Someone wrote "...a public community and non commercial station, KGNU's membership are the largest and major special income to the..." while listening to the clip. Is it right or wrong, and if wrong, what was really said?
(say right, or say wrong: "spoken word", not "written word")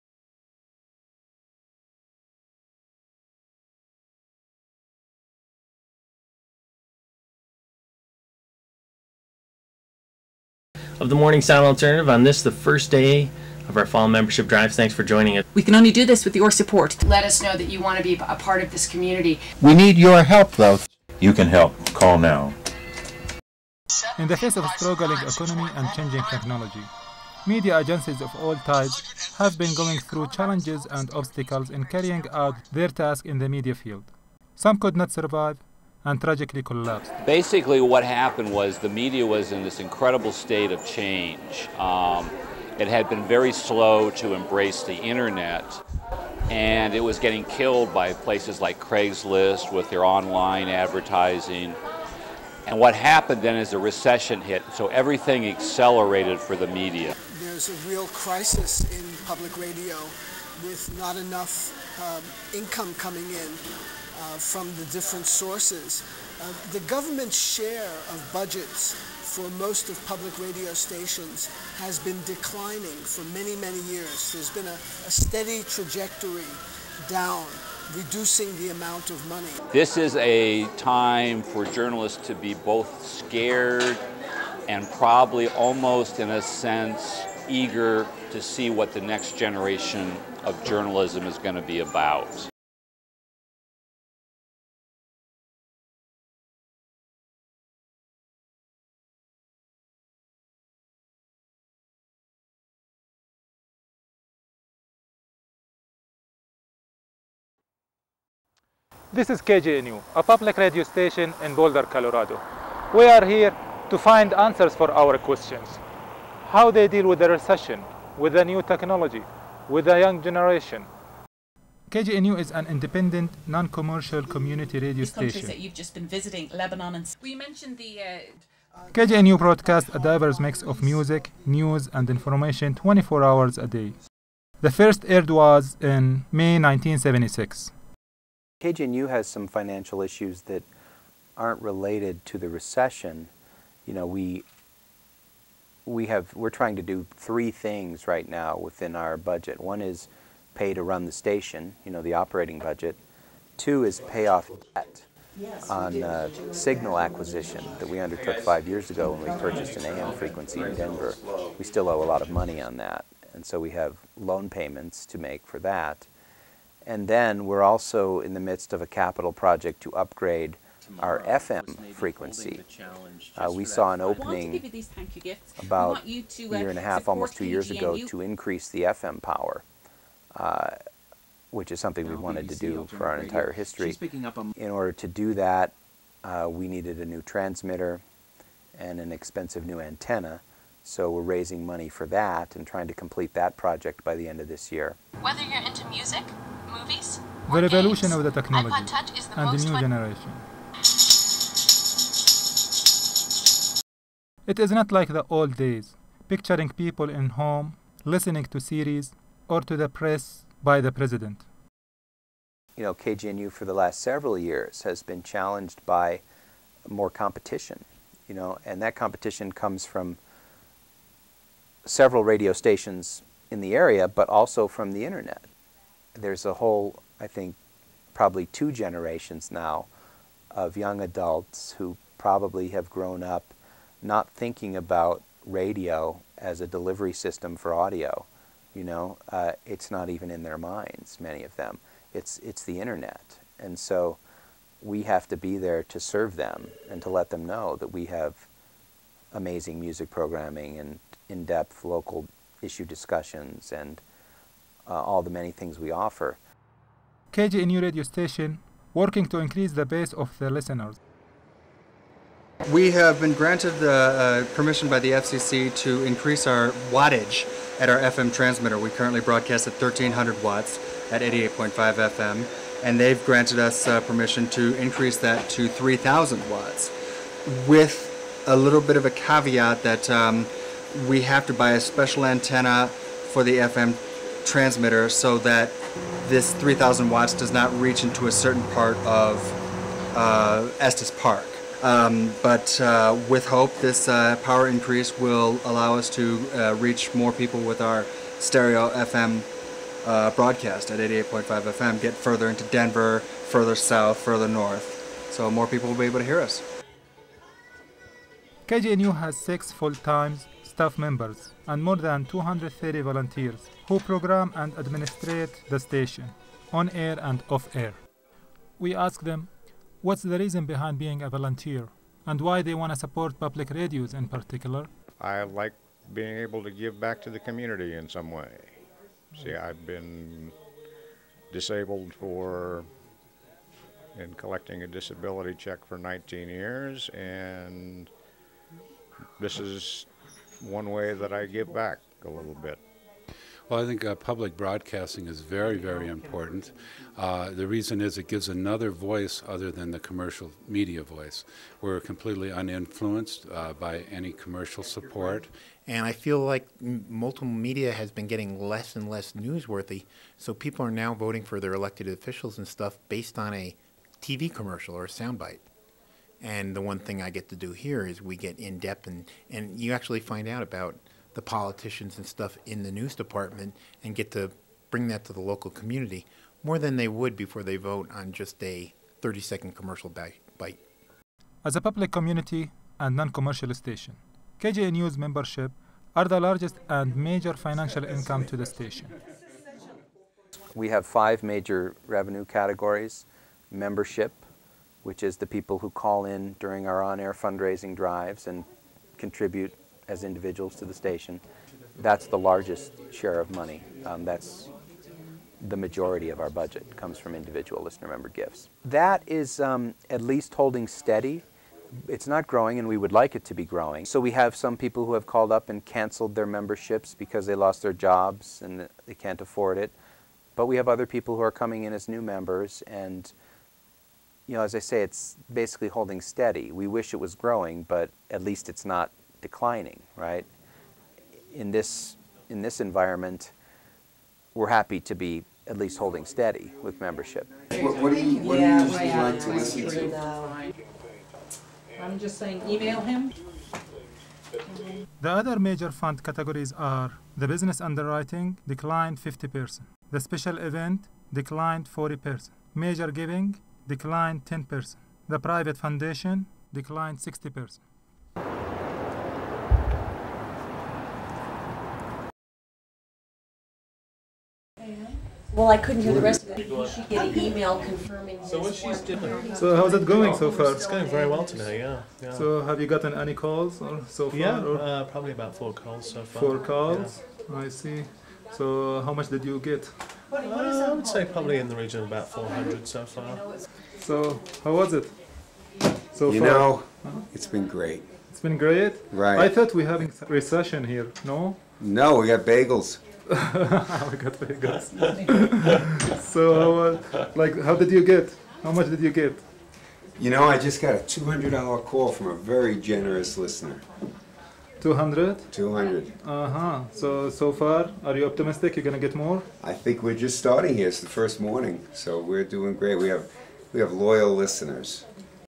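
wrong: "financial", not "special".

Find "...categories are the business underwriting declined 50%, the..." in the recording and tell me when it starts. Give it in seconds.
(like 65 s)
446 s.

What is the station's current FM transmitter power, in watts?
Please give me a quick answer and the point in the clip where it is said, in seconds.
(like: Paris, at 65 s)
1300 watts, at 269 s.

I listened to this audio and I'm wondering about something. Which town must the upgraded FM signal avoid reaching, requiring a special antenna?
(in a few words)
Estes Park.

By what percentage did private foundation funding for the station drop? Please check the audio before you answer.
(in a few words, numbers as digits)
60%.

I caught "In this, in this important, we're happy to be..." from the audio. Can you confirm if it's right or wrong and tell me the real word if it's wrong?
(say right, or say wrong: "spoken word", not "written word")
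wrong: "environment", not "important".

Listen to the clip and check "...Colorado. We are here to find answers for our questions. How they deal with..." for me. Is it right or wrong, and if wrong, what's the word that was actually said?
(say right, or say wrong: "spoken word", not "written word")
right.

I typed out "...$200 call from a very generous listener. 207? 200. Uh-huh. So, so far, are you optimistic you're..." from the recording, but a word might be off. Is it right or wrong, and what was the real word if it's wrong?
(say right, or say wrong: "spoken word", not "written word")
wrong: "200", not "207".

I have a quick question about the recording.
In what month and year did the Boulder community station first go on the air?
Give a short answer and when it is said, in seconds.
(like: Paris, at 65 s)
May 1976, at 136 s.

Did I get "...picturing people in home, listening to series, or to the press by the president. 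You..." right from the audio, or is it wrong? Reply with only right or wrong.
right.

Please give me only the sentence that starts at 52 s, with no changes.
And what happened then is a recession hit, so everything accelerated for the media.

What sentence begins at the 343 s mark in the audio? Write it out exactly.
Well, I think uh, public broadcasting is very, very important.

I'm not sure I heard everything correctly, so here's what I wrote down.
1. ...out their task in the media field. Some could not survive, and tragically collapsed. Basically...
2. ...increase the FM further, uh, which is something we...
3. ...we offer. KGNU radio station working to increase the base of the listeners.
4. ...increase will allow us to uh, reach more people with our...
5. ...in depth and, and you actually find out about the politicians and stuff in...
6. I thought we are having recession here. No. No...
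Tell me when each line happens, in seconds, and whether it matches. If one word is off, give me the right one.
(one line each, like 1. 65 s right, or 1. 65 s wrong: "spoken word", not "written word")
1. 32 s right
2. 178 s wrong: "power", not "further"
3. 255 s right
4. 294 s right
5. 368 s right
6. 489 s right.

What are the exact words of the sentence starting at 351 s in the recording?
We're completely uninfluenced uh, by any commercial support.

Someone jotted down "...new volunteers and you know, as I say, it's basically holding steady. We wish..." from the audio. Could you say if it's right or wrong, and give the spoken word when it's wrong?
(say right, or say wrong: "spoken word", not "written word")
wrong: "members", not "volunteers".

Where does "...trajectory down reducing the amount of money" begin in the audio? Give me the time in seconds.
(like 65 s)
75 s.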